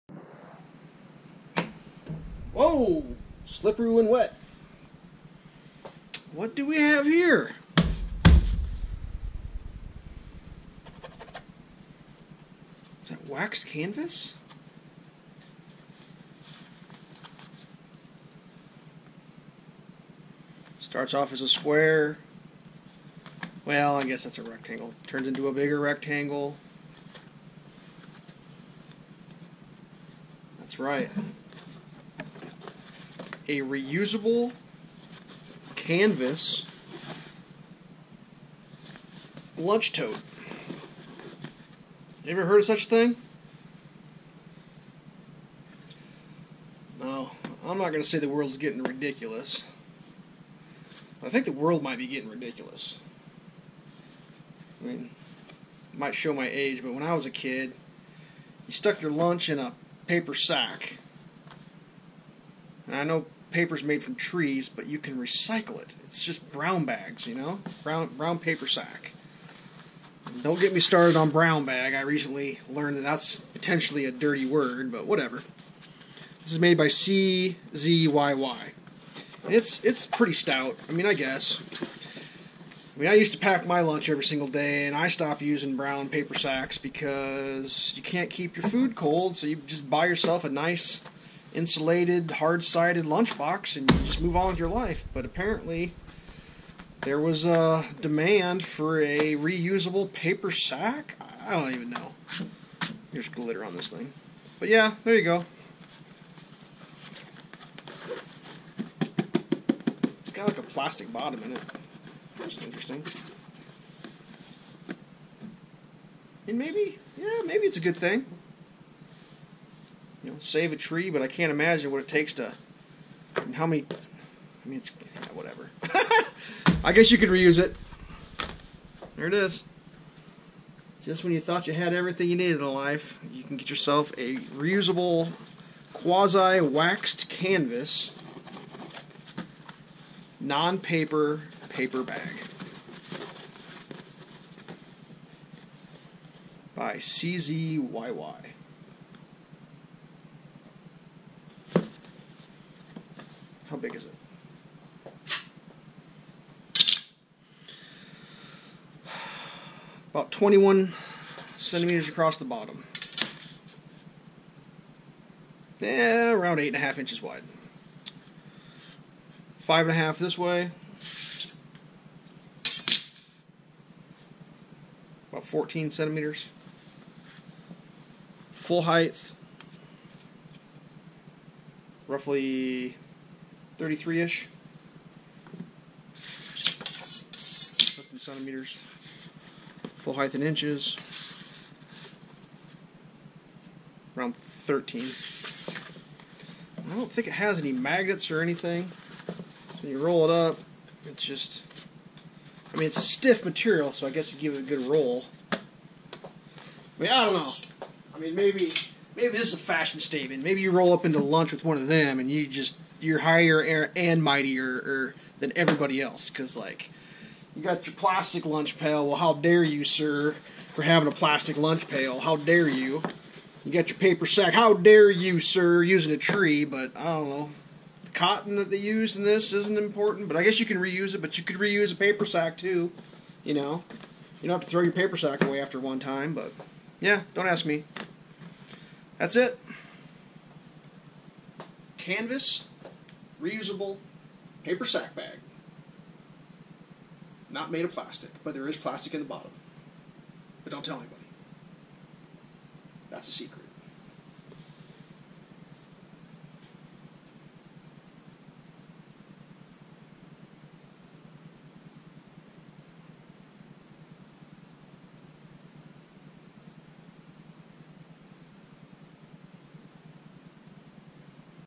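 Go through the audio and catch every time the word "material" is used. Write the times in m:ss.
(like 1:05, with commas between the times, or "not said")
3:23.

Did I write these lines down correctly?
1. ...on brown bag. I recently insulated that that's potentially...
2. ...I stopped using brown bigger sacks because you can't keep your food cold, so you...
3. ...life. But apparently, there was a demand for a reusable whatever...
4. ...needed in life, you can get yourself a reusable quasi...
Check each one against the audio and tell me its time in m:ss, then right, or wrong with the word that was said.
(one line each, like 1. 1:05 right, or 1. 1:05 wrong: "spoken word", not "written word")
1. 1:11 wrong: "learned", not "insulated"
2. 1:24 wrong: "paper", not "bigger"
3. 1:34 wrong: "paper", not "whatever"
4. 2:12 right.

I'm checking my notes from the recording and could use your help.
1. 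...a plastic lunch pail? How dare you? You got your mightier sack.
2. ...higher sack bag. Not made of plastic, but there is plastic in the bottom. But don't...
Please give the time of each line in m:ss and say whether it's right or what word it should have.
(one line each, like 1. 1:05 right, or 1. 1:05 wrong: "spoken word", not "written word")
1. 3:41 wrong: "paper", not "mightier"
2. 4:04 wrong: "paper", not "higher".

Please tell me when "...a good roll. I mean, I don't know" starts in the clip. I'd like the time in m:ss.
3:24.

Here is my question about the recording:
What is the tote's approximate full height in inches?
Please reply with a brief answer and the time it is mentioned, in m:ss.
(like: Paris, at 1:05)
13, at 3:14.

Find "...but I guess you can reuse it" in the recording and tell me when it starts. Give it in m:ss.
3:50.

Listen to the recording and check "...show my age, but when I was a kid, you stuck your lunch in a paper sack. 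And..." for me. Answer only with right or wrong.
right.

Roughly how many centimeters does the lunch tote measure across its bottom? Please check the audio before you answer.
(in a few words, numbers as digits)
21 centimeters.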